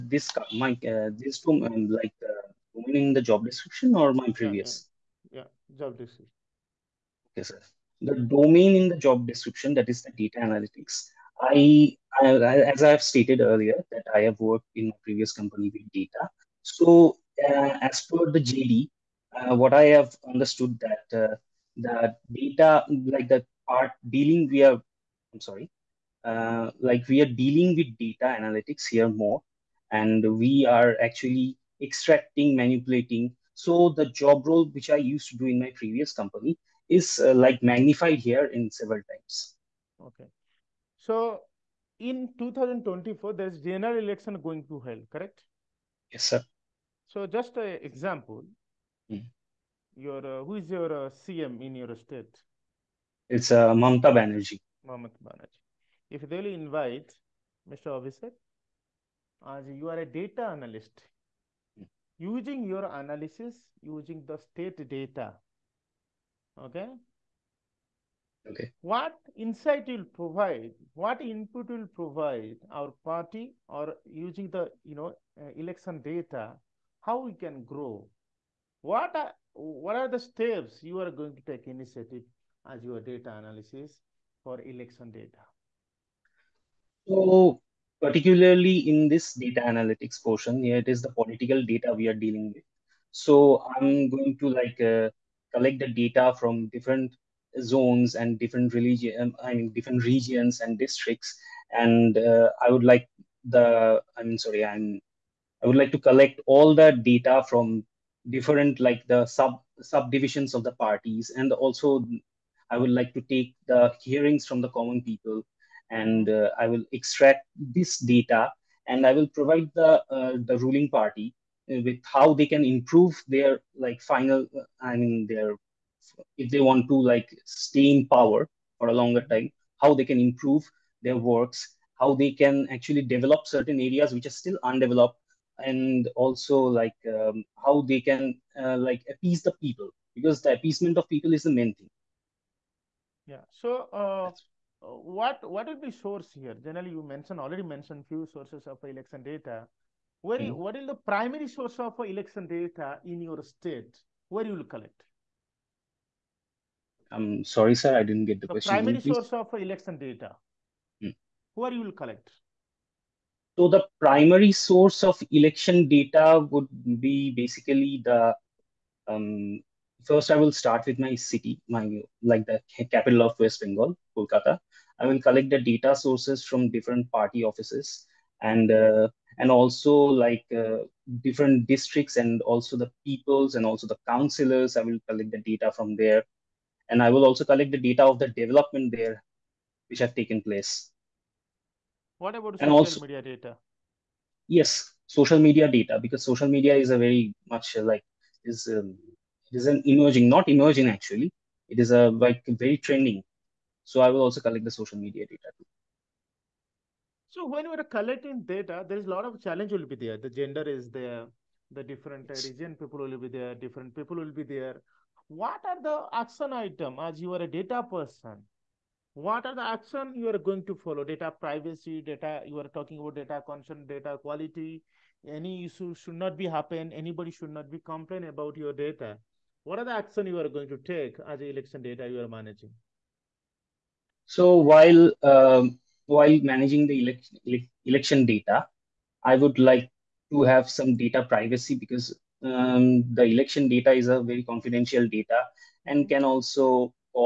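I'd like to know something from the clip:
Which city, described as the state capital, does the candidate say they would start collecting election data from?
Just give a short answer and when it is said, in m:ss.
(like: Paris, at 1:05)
Kolkata, at 2:54.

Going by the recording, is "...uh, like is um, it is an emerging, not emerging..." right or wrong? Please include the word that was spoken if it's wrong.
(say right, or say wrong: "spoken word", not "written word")
right.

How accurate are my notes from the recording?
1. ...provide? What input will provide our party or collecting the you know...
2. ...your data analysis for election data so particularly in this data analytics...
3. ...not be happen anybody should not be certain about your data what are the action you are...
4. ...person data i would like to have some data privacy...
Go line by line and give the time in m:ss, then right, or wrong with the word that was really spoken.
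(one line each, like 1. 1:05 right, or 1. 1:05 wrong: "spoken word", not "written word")
1. 1:10 wrong: "using", not "collecting"
2. 1:22 right
3. 3:46 wrong: "complain", not "certain"
4. 3:57 wrong: "election", not "person".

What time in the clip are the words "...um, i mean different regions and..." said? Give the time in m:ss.
1:39.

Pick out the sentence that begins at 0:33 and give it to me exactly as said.
So the job role which I used to do in my previous company is uh, like magnified here in several times.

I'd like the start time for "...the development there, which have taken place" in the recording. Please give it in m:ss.
3:08.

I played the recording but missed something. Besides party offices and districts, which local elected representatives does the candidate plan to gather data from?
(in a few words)
councillors.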